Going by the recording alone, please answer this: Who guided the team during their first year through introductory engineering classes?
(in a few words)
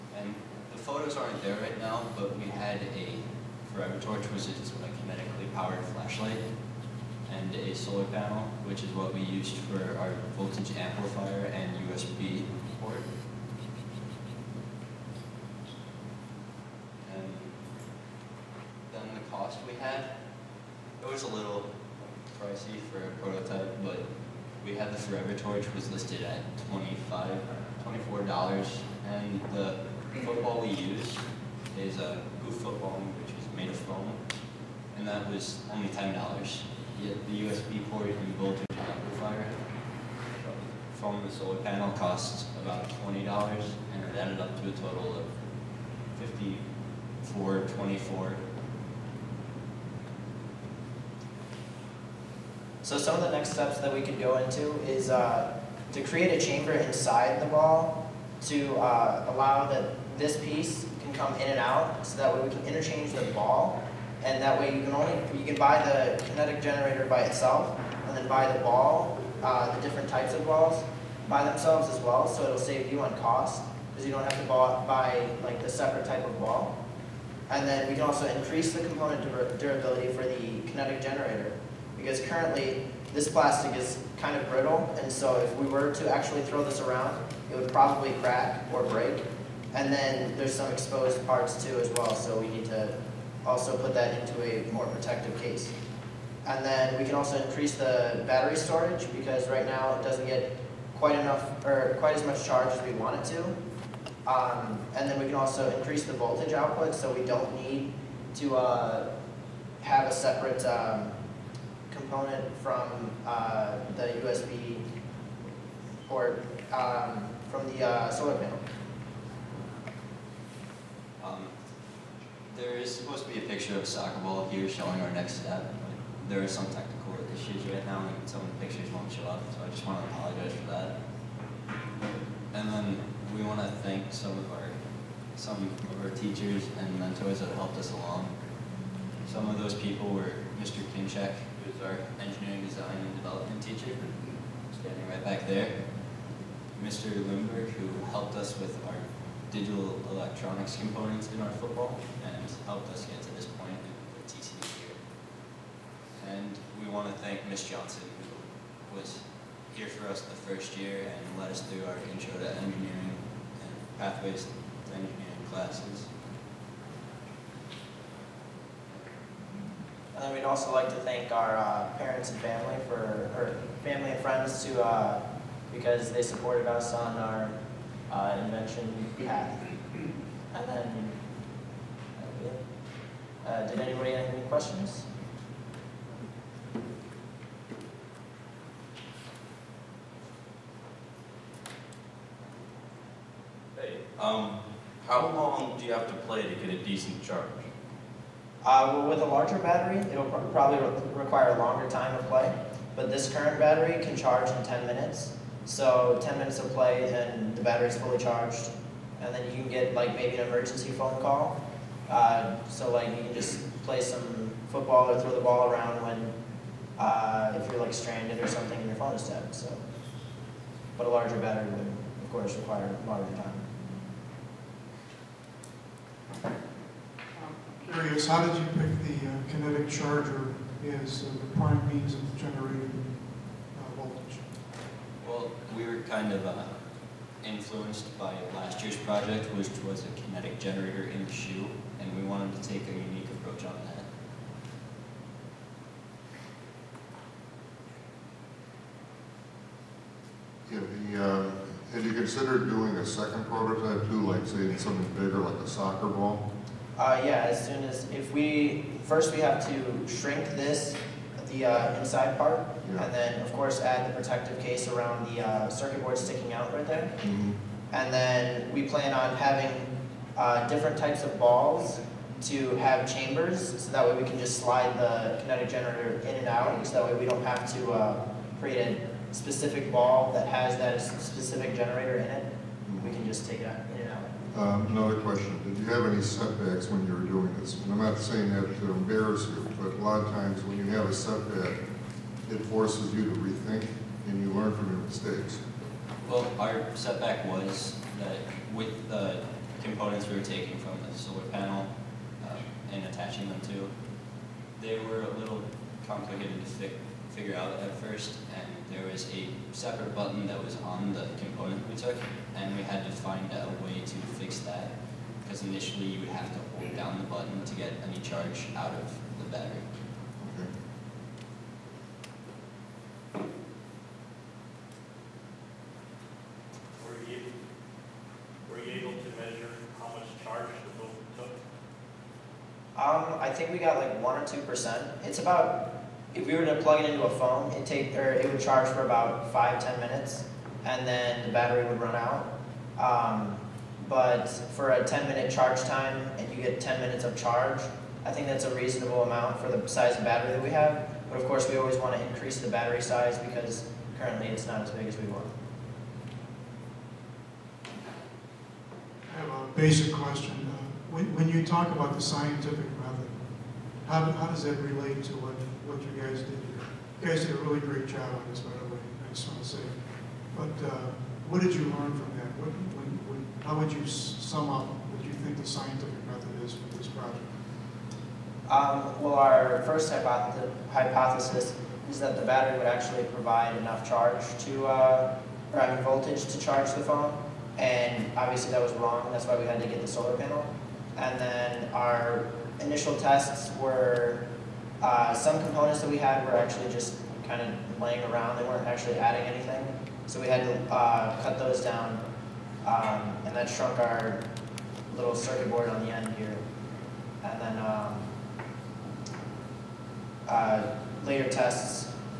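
Ms. Johnson.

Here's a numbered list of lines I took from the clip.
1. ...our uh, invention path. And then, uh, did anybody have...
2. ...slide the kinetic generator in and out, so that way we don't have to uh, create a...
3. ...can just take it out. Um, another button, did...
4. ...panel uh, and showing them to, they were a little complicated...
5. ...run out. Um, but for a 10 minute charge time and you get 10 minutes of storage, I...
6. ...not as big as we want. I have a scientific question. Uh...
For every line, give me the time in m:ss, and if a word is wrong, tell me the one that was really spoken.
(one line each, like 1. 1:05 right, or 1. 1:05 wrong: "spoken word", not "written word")
1. 2:57 right
2. 4:34 right
3. 4:43 wrong: "question", not "button"
4. 5:01 wrong: "attaching", not "showing"
5. 5:42 wrong: "charge", not "storage"
6. 5:54 wrong: "basic", not "scientific".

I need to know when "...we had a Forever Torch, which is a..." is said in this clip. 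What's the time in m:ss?
0:02.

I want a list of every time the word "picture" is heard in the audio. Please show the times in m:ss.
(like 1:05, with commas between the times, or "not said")
2:03, 2:08.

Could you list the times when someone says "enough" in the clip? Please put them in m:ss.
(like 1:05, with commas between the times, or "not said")
1:41, 6:23.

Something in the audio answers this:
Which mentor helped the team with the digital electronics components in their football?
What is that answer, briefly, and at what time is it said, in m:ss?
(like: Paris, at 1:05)
Mr. Lindberg, at 2:26.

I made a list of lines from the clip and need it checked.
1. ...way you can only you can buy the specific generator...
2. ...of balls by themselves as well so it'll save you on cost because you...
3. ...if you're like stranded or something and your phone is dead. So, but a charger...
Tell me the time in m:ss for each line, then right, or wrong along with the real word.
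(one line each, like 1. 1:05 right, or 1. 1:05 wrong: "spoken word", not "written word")
1. 1:04 wrong: "kinetic", not "specific"
2. 1:10 right
3. 3:37 wrong: "larger", not "charger".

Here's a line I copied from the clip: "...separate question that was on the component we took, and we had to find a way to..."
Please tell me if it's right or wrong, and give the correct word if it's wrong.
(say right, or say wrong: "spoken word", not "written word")
wrong: "button", not "question".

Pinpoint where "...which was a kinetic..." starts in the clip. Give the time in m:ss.
3:59.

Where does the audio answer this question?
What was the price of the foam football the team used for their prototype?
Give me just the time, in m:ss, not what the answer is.
0:35.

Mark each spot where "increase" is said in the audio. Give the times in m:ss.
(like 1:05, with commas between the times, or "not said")
1:18, 1:37, 1:45, 5:52.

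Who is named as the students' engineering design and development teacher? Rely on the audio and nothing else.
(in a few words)
Mr. Kinchek.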